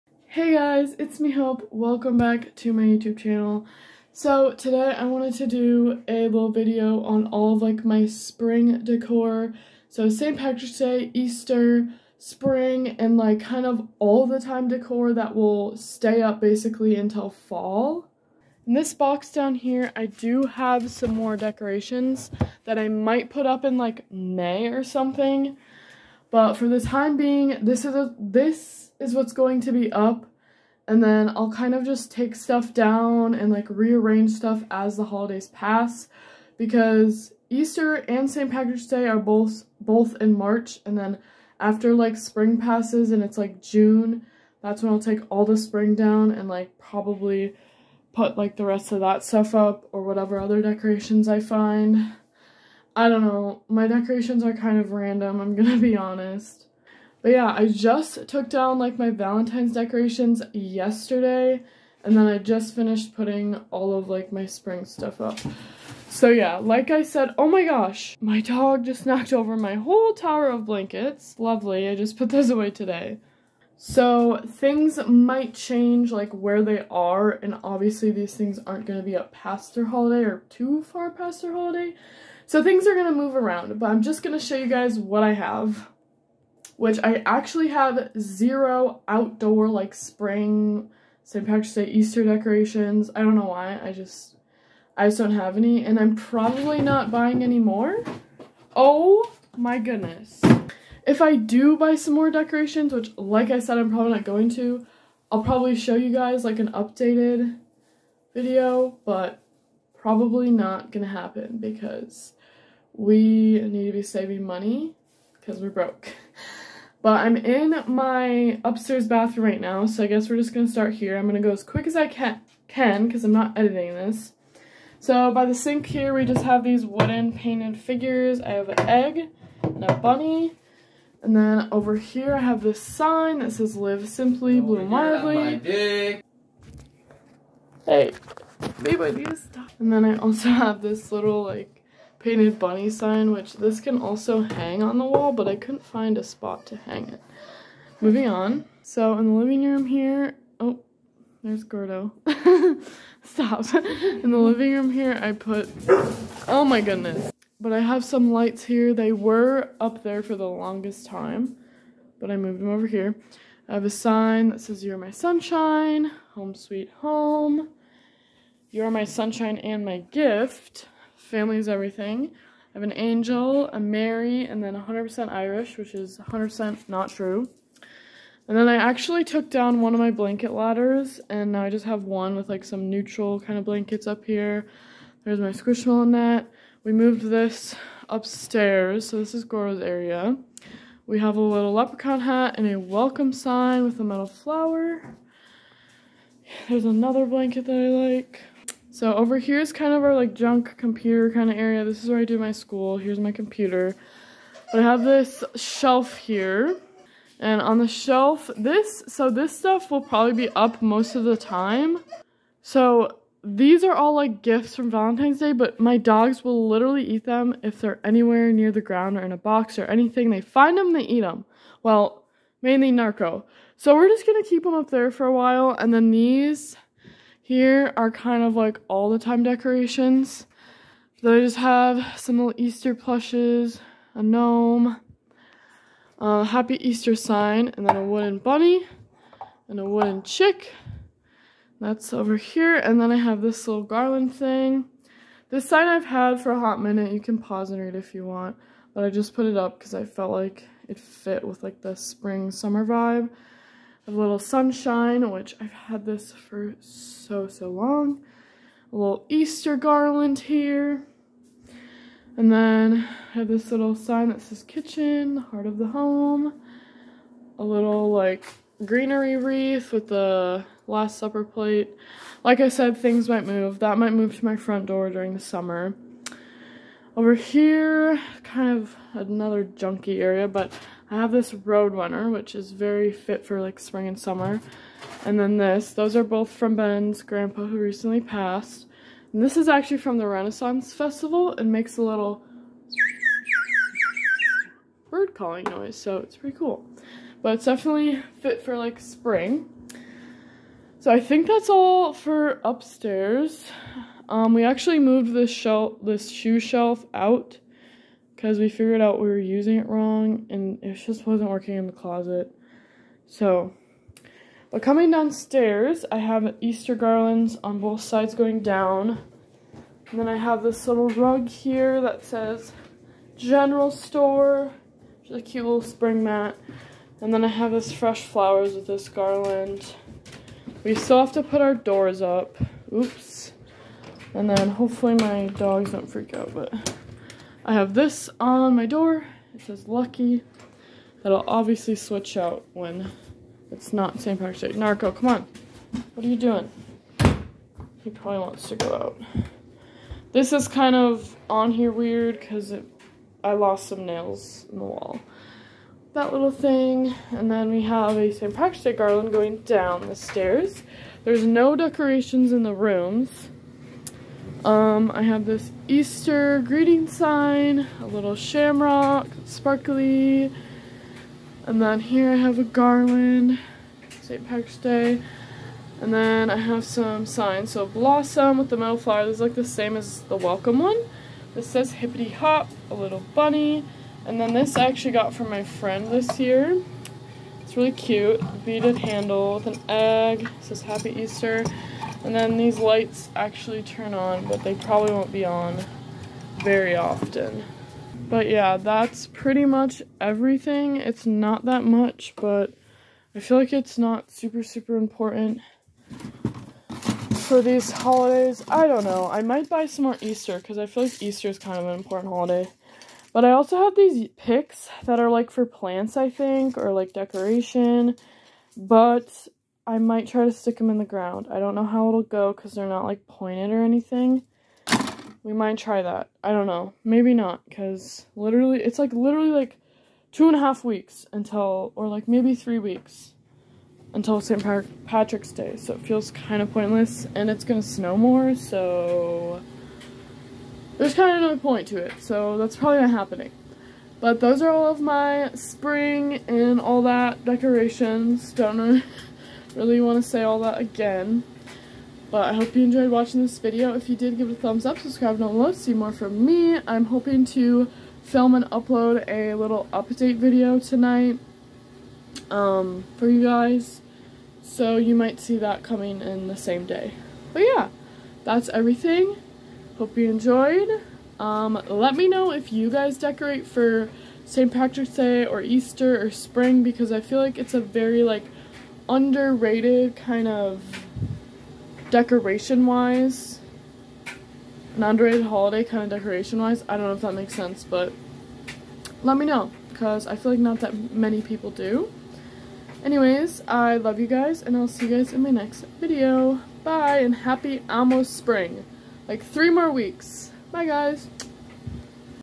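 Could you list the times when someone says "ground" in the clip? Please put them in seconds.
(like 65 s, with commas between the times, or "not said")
218 s, 421 s.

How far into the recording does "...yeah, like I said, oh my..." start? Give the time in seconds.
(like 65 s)
66 s.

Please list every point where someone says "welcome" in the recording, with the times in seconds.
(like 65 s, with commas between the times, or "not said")
1 s, 192 s, 380 s.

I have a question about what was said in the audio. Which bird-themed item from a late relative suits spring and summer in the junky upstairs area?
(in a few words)
Roadrunner.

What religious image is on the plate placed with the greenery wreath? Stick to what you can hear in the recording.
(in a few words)
The Last Supper.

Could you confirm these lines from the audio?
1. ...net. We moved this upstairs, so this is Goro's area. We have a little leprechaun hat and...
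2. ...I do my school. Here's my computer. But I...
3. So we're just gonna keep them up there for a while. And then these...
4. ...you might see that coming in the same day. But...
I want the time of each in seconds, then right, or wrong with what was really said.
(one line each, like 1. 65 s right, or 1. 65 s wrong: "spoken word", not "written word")
1. 186 s right
2. 202 s right
3. 223 s right
4. 464 s right.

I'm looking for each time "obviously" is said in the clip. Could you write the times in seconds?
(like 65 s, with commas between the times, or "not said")
77 s, 341 s.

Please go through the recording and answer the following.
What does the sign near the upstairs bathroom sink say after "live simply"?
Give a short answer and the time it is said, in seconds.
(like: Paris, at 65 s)
Bloom wildly, at 134 s.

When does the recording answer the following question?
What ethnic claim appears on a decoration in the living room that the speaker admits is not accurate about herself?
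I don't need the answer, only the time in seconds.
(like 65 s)
174 s.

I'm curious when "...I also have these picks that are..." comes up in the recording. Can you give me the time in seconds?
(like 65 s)
413 s.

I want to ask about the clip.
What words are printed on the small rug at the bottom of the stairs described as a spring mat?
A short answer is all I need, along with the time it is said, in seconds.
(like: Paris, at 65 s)
General Store, at 323 s.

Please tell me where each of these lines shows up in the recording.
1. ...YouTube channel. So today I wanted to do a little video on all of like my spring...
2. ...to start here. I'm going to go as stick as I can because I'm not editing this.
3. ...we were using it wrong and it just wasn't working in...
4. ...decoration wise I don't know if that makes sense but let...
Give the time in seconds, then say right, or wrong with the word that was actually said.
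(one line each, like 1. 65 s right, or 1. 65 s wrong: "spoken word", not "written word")
1. 2 s right
2. 120 s wrong: "quick", not "stick"
3. 309 s right
4. 486 s right.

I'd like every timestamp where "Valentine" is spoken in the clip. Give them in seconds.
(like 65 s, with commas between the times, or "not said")
59 s, 214 s.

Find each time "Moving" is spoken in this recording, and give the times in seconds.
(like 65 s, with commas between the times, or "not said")
147 s.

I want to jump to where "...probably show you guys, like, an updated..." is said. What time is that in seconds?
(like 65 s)
105 s.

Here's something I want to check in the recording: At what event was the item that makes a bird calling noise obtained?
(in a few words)
Renaissance Festival.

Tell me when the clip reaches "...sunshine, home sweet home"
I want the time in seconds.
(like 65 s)
165 s.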